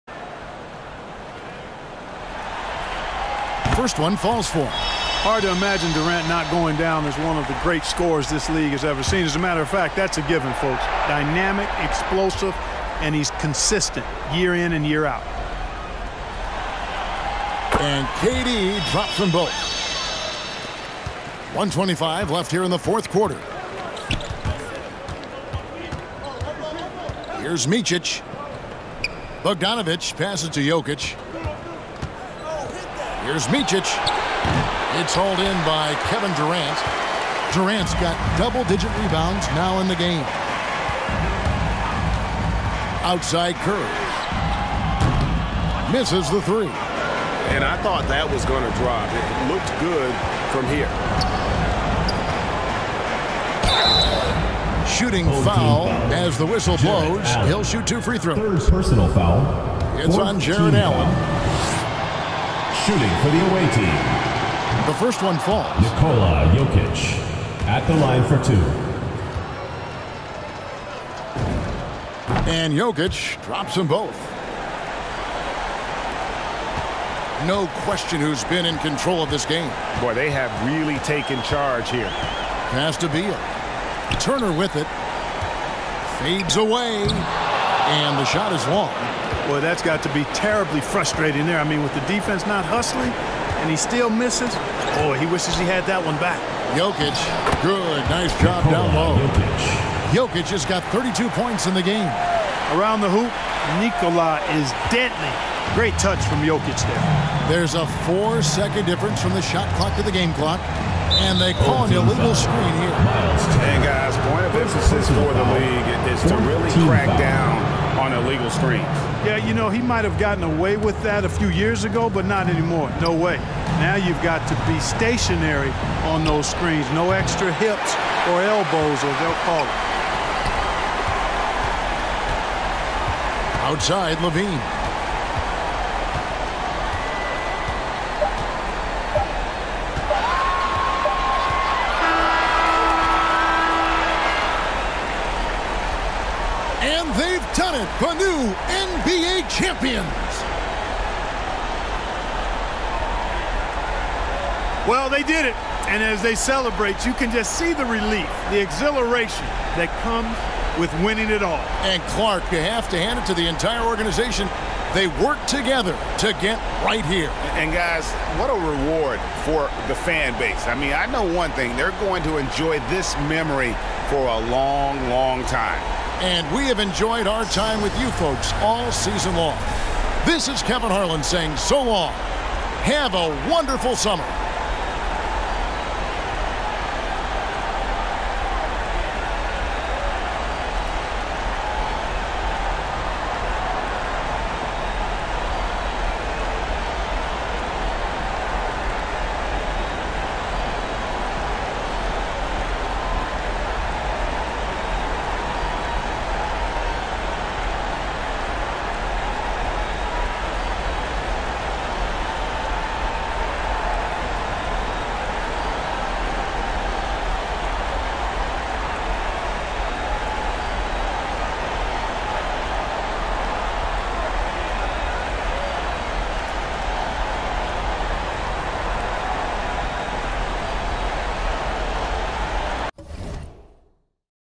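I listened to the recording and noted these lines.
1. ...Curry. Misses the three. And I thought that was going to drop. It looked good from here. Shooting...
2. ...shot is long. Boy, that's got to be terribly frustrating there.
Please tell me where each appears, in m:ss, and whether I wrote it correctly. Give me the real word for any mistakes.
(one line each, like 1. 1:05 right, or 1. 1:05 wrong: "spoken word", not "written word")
1. 0:43 right
2. 1:28 right.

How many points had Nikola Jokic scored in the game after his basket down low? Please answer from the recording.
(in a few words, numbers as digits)
32.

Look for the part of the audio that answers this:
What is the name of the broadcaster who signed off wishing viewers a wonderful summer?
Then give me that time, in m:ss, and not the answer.
3:00.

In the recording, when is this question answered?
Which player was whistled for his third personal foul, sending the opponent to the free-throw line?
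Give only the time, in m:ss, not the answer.
1:00.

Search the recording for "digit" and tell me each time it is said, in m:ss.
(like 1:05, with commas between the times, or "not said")
0:38.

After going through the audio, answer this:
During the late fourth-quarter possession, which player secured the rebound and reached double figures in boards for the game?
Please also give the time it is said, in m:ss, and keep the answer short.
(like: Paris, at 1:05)
Kevin Durant, at 0:36.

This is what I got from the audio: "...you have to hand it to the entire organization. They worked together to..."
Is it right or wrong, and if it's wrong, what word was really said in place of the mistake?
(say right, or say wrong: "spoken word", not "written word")
right.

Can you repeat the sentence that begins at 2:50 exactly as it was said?
I mean, I know one thing.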